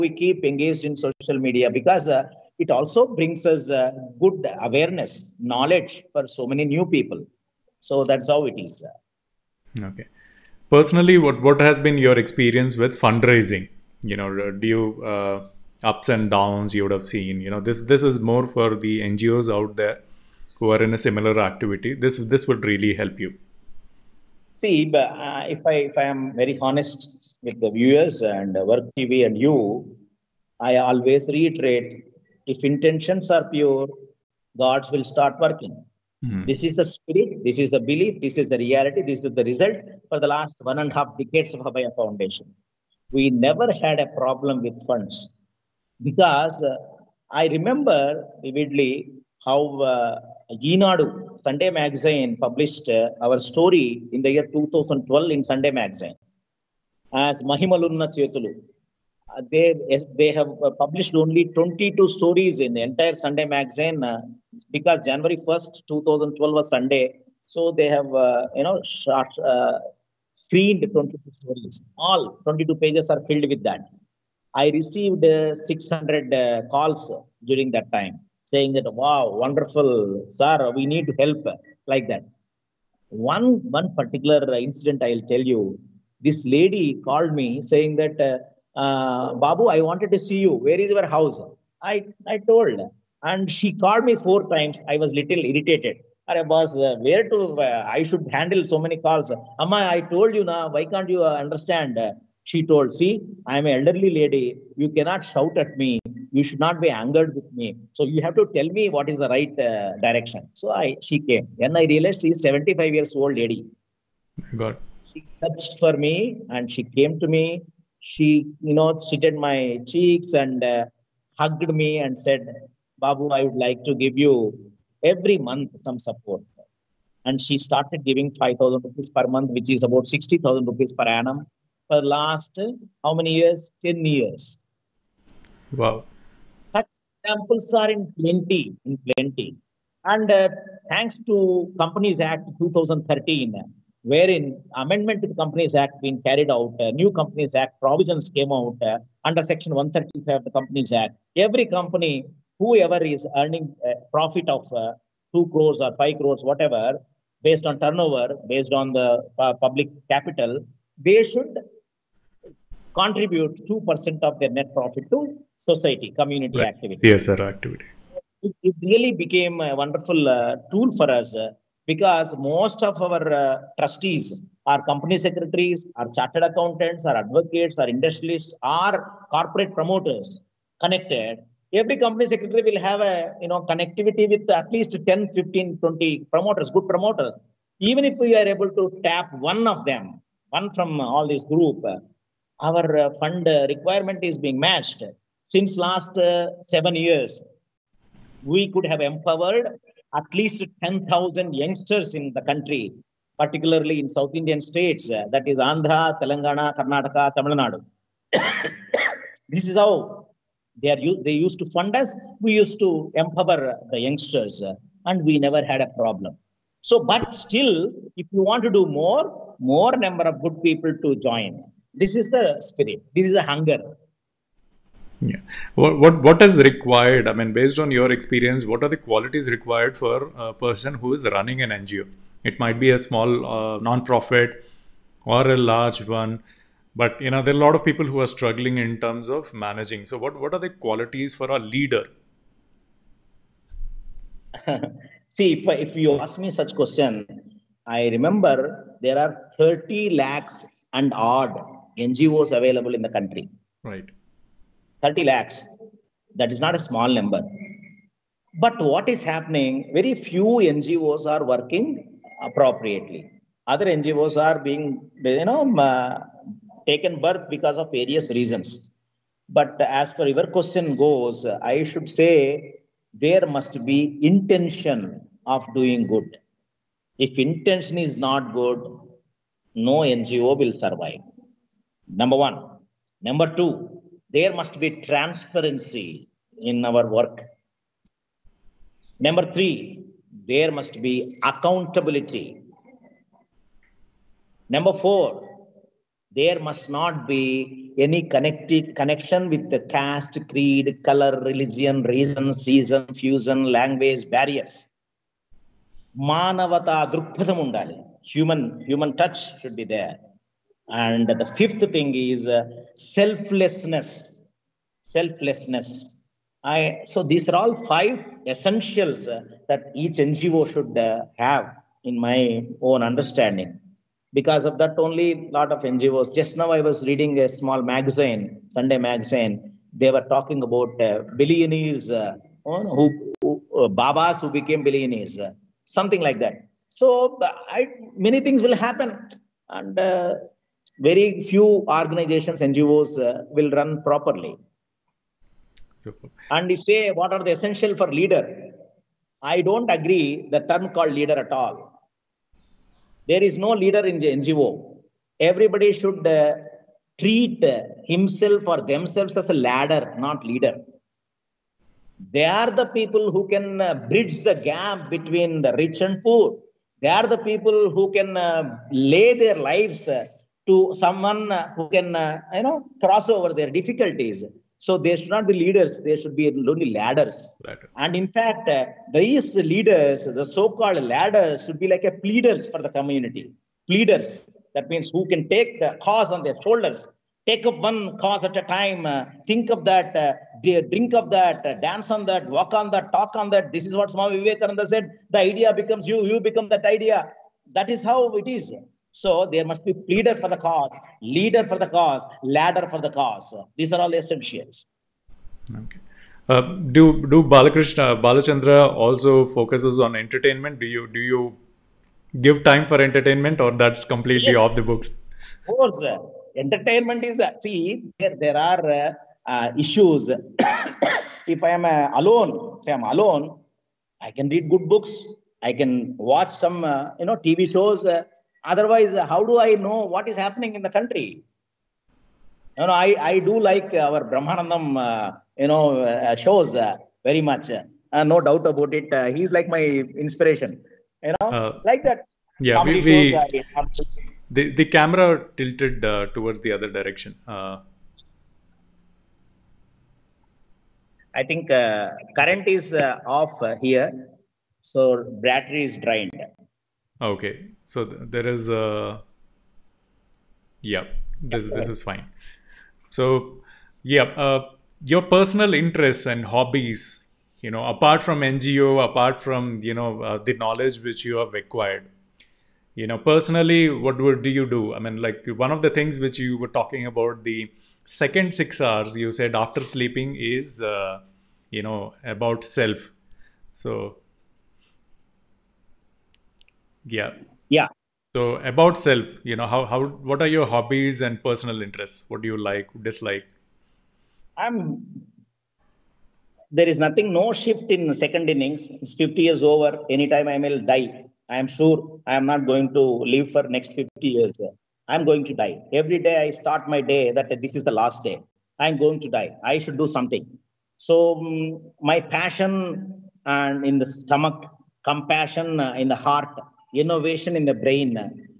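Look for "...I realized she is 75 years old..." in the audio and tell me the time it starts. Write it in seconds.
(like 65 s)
111 s.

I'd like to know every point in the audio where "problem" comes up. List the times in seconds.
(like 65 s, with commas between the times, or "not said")
44 s, 215 s.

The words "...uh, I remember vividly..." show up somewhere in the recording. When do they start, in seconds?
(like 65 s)
46 s.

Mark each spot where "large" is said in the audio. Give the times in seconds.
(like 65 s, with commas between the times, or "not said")
235 s.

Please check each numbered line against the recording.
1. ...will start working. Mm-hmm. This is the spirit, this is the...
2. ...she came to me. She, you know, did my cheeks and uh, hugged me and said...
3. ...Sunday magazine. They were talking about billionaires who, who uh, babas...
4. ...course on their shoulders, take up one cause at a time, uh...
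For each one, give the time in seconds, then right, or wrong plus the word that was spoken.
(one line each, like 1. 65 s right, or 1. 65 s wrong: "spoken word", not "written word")
1. 34 s right
2. 116 s right
3. 328 s right
4. 386 s wrong: "cause", not "course".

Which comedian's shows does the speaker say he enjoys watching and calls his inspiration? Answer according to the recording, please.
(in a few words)
Brahmanandam.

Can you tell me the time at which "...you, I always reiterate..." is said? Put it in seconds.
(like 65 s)
29 s.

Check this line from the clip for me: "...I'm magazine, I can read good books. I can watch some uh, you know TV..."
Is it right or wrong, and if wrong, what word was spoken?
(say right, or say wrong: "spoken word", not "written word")
wrong: "alone", not "magazine".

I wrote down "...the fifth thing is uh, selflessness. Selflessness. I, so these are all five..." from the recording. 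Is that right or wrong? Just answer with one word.
right.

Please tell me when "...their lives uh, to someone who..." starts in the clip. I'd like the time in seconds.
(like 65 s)
369 s.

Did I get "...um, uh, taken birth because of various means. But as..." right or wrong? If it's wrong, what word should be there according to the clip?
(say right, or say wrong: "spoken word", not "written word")
wrong: "reasons", not "means".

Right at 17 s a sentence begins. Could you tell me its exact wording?
You know, this this is more for the NGOs out there who are in a similar activity.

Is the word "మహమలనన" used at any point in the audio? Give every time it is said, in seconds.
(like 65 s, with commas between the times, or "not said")
57 s.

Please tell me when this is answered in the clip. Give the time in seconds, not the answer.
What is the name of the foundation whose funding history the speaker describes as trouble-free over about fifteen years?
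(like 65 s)
41 s.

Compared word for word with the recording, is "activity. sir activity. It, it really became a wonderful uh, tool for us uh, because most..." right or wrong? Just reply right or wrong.
right.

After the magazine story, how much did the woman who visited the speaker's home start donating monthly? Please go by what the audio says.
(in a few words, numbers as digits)
5,000 rupees.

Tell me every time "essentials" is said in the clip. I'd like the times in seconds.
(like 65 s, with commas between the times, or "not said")
318 s, 347 s, 404 s.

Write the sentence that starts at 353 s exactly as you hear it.
There is no leader in the NGO.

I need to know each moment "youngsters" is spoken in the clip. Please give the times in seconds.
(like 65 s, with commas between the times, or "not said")
201 s, 213 s.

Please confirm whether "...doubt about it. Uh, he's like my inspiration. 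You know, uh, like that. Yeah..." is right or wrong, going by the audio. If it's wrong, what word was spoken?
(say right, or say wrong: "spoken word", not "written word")
right.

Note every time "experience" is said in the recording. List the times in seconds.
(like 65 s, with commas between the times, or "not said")
12 s, 228 s.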